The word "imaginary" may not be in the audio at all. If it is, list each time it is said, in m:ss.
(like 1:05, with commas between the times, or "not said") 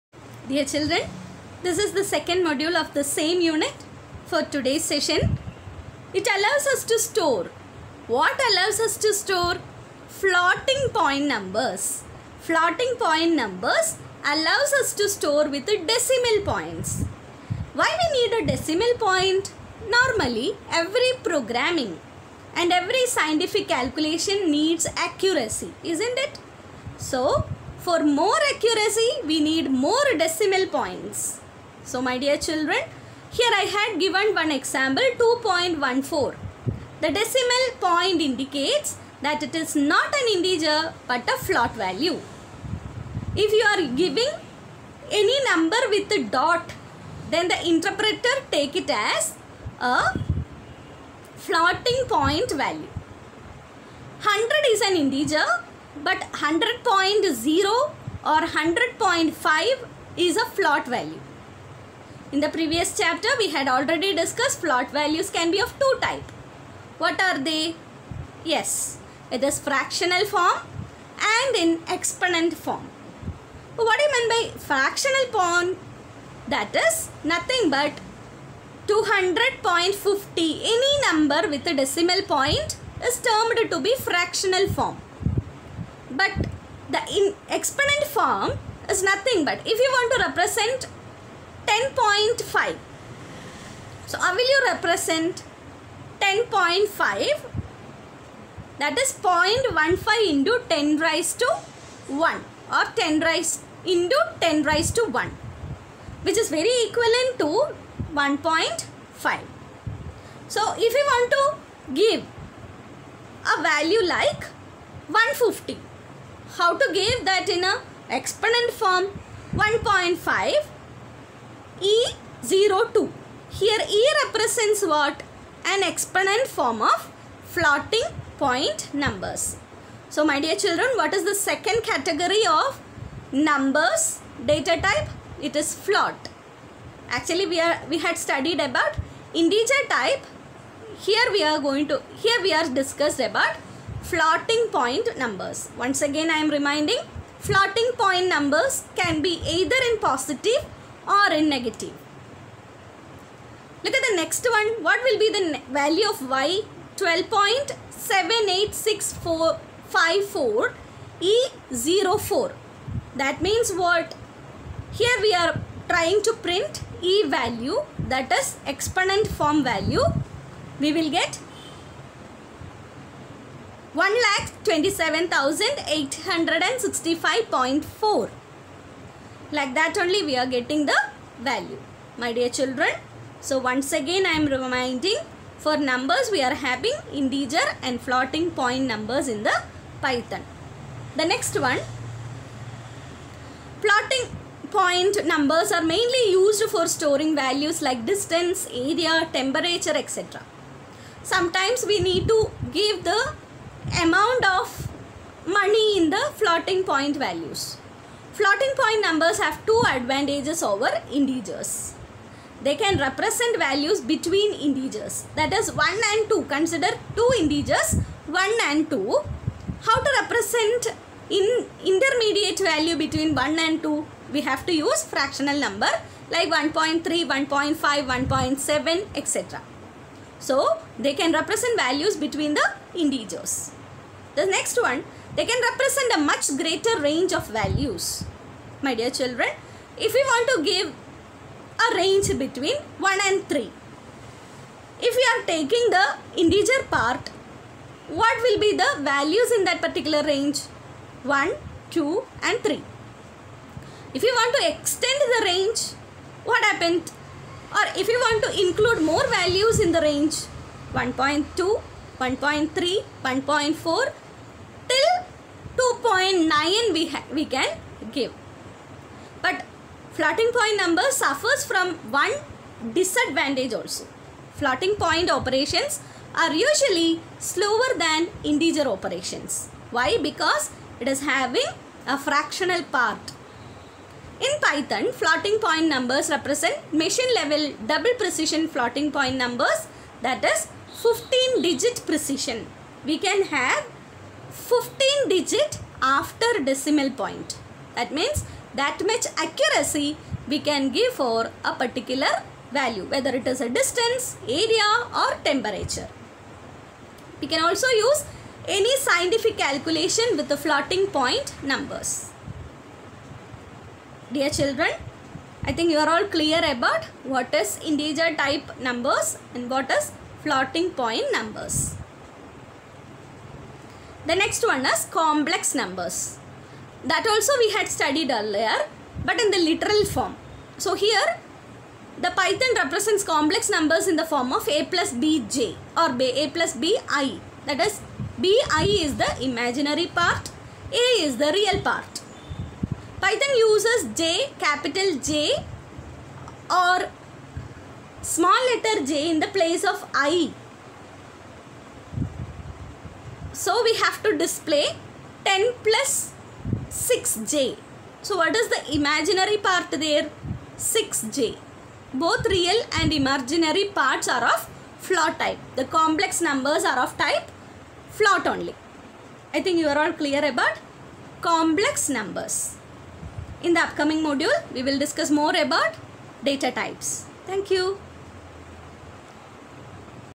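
5:39, 5:58, 6:03.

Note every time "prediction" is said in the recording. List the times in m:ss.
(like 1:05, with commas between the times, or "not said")
not said.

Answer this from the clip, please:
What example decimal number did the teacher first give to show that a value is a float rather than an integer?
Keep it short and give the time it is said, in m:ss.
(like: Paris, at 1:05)
2.14, at 0:35.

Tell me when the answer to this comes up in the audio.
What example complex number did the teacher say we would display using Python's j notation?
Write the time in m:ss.
5:55.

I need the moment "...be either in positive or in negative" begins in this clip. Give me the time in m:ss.
2:29.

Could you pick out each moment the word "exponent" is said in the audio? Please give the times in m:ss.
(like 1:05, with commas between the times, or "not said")
1:11, 1:27, 1:58, 2:05, 2:48.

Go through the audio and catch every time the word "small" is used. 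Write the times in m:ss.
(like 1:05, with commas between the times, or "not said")
5:48.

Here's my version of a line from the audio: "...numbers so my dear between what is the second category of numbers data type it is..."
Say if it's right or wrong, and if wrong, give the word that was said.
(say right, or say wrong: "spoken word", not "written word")
wrong: "children", not "between".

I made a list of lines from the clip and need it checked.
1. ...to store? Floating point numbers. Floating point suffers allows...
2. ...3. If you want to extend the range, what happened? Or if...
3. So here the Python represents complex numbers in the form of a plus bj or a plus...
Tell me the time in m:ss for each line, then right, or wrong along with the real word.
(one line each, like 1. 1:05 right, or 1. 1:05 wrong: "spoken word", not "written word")
1. 0:08 wrong: "numbers", not "suffers"
2. 4:12 right
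3. 5:30 right.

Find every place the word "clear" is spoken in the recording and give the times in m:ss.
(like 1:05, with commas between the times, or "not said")
5:16, 6:10.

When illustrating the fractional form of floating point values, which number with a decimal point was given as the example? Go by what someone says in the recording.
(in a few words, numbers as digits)
200.50.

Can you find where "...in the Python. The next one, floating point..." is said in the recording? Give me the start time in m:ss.
3:09.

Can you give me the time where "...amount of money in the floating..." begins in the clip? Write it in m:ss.
3:23.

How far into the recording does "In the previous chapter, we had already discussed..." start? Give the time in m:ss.
1:02.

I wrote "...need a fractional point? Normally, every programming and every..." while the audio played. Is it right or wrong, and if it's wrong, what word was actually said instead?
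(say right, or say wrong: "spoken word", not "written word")
wrong: "decimal", not "fractional".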